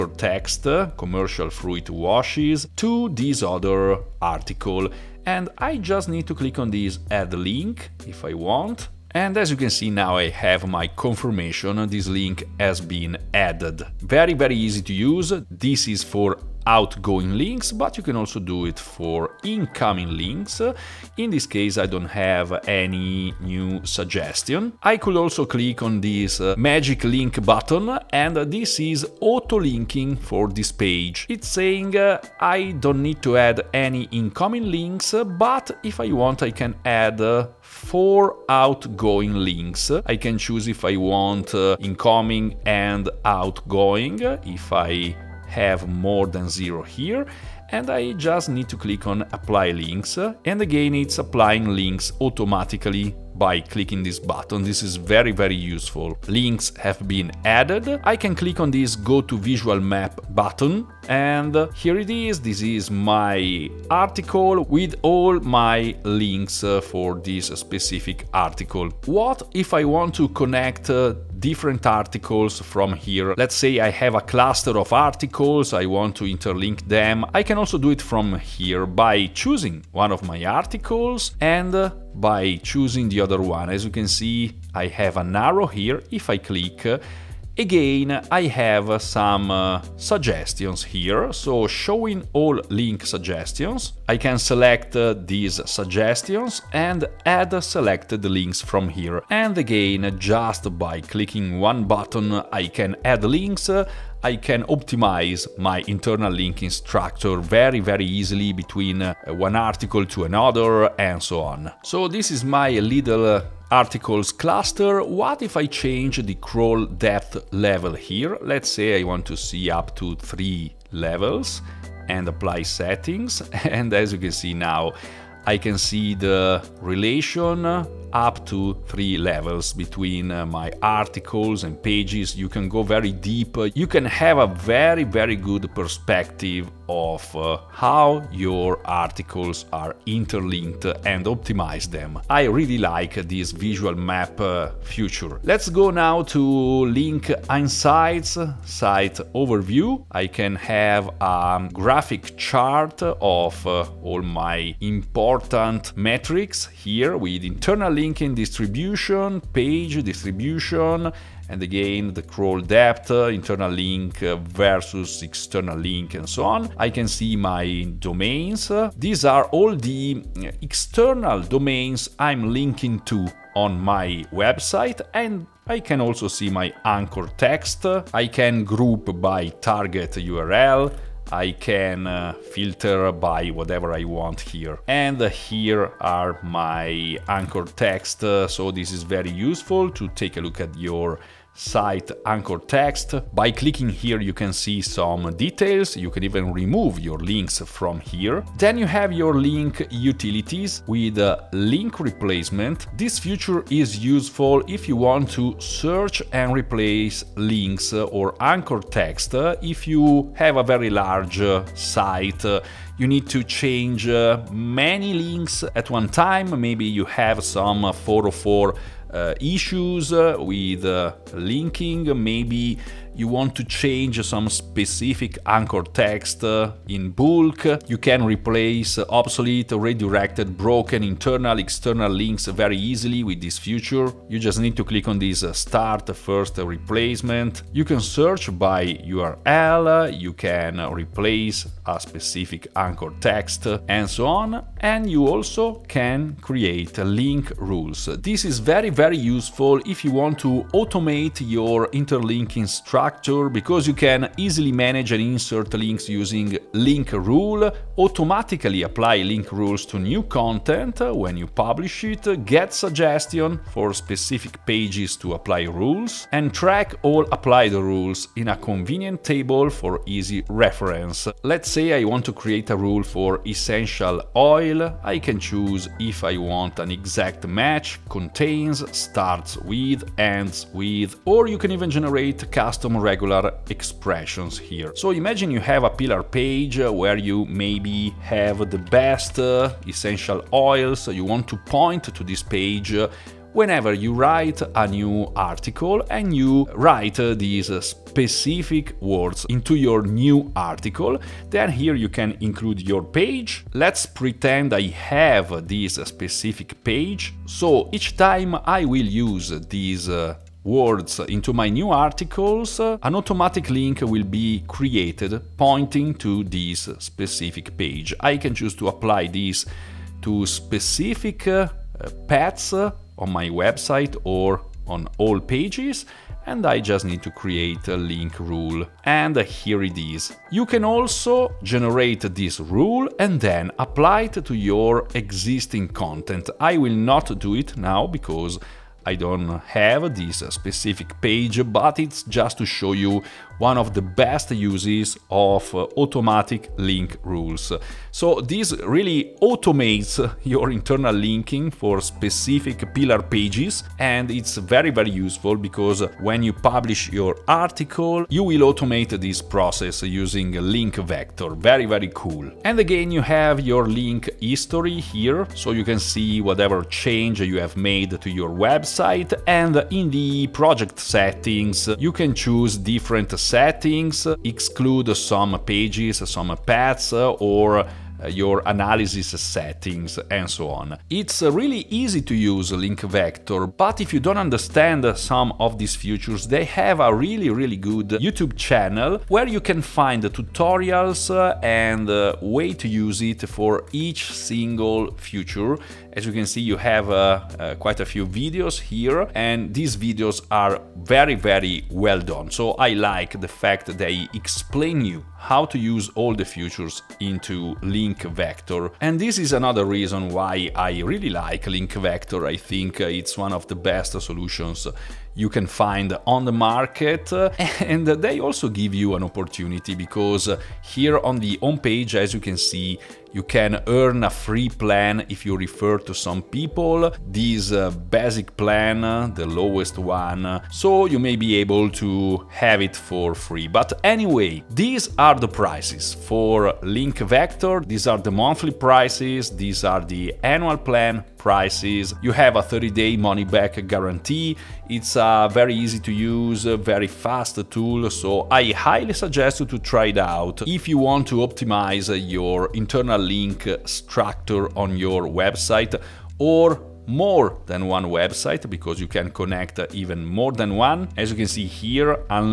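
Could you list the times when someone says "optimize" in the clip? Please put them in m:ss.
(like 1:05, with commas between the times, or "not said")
1:44, 2:21, 7:31.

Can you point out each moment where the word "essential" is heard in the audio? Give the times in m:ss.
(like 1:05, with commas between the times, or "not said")
4:33, 4:49.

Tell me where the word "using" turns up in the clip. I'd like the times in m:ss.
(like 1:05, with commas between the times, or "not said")
4:16, 6:00.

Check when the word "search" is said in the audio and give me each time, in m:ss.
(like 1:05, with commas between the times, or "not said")
3:25, 3:57.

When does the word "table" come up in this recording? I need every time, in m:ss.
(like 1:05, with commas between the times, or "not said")
4:29.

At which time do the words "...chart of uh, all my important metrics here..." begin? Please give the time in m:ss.
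2:32.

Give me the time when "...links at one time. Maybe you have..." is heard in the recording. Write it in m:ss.
3:35.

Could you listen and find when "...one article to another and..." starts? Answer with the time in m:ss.
1:49.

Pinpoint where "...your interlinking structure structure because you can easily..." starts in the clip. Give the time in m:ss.
4:11.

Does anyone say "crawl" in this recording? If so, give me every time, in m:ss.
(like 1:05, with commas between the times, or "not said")
1:56, 2:42.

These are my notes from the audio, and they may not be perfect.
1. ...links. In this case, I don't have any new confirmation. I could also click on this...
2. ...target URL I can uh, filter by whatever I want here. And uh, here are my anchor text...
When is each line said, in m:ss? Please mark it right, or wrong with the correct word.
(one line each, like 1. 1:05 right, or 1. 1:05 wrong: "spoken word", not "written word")
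1. 0:20 wrong: "suggestion", not "confirmation"
2. 2:59 right.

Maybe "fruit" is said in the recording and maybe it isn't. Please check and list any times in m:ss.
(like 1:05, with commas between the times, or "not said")
0:01.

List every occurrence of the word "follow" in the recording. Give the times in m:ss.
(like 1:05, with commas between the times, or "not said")
not said.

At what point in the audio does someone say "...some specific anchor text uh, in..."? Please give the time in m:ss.
3:44.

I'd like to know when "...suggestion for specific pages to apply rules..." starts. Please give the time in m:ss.
4:22.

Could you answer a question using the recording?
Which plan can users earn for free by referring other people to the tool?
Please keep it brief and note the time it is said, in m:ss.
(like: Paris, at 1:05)
Basic plan, at 7:08.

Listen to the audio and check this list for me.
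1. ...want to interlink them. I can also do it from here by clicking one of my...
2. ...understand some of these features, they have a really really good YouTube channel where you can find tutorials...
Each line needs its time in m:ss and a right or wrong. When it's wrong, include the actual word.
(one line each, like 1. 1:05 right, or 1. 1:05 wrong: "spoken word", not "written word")
1. 1:15 wrong: "choosing", not "clicking"
2. 6:24 right.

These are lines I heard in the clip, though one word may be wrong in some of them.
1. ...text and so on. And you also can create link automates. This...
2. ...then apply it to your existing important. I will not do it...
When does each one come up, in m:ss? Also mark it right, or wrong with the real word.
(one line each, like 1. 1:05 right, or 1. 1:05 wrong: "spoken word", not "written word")
1. 4:03 wrong: "rules", not "automates"
2. 5:33 wrong: "content", not "important".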